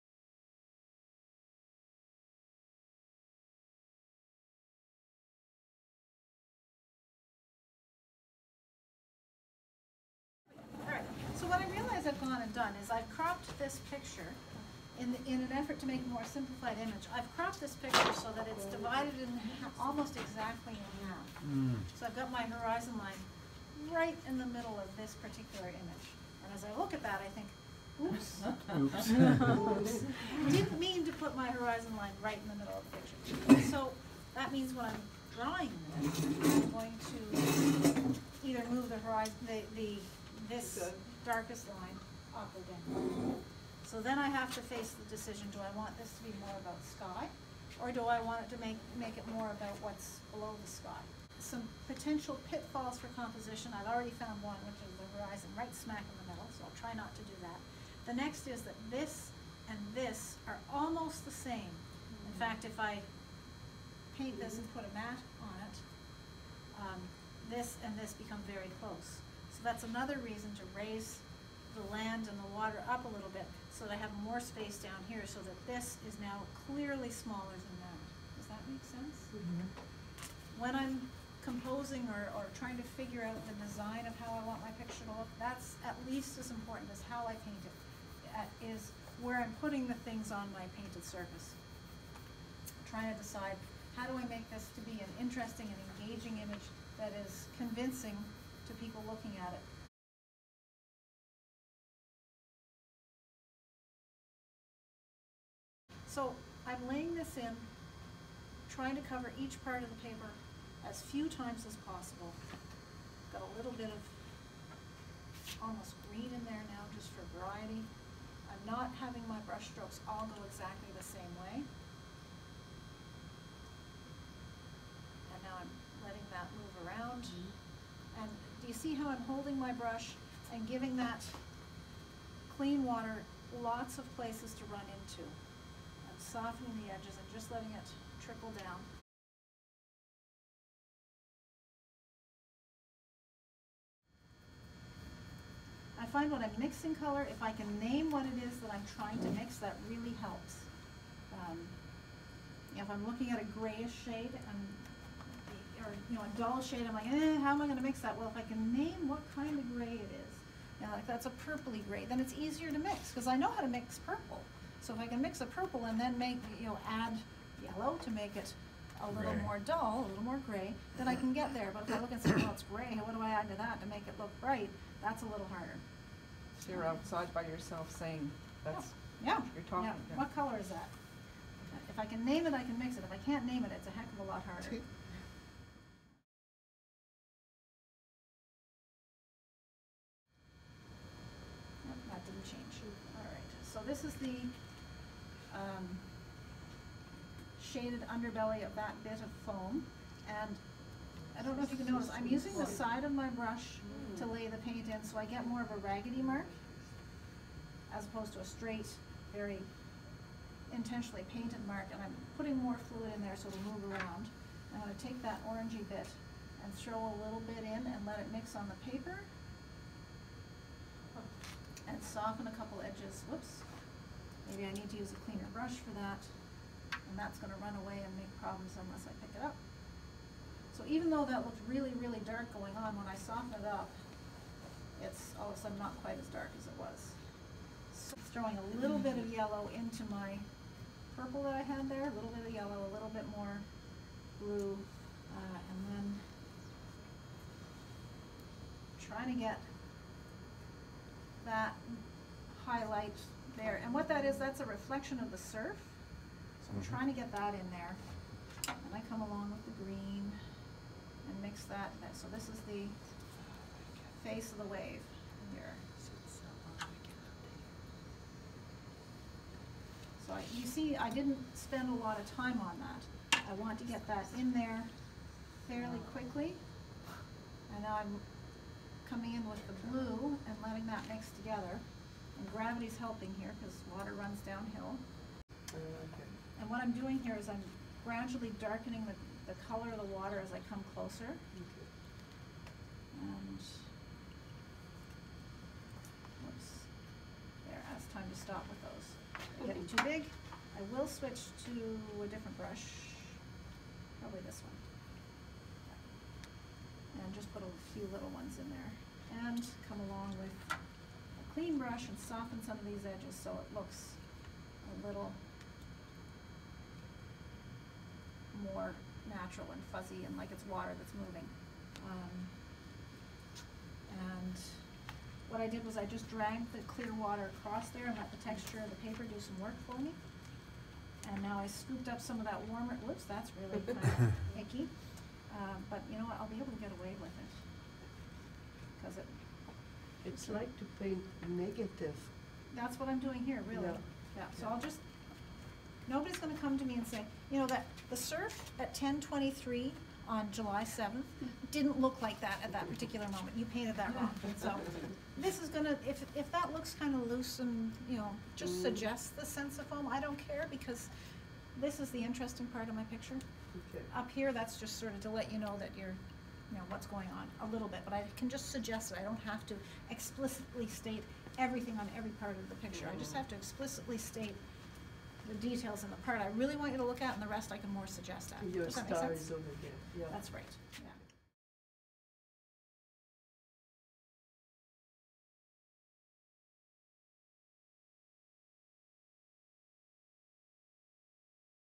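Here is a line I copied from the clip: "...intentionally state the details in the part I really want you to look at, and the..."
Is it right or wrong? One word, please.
wrong.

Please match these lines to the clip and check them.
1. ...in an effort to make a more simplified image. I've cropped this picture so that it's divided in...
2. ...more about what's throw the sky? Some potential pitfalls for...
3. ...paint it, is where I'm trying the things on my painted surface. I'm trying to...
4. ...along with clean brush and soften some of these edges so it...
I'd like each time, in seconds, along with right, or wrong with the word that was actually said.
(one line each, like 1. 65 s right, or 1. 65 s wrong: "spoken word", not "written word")
1. 15 s right
2. 49 s wrong: "below", not "throw"
3. 87 s wrong: "putting", not "trying"
4. 310 s right.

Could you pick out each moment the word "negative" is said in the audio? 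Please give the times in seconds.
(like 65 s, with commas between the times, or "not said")
341 s.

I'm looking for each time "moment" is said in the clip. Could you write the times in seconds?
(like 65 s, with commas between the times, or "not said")
353 s.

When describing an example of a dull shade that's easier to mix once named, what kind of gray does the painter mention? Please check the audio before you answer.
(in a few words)
purpley gray.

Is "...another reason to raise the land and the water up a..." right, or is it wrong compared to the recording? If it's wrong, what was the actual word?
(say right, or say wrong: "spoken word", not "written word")
right.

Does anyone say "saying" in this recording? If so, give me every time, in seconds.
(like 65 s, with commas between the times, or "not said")
177 s.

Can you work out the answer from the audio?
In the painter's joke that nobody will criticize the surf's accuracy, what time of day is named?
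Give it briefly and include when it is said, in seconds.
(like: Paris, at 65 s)
10:23, at 348 s.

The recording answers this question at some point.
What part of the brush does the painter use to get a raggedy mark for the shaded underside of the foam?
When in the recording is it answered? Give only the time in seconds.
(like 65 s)
202 s.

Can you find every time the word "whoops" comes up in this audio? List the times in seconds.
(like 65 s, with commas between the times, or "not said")
223 s, 293 s, 333 s.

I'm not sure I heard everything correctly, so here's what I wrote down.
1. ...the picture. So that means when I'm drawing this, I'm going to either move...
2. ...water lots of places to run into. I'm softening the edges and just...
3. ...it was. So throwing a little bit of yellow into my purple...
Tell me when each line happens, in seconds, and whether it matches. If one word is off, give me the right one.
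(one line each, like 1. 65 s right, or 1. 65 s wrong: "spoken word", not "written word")
1. 32 s right
2. 132 s right
3. 236 s right.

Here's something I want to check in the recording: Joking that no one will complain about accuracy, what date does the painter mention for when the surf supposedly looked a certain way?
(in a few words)
July 7.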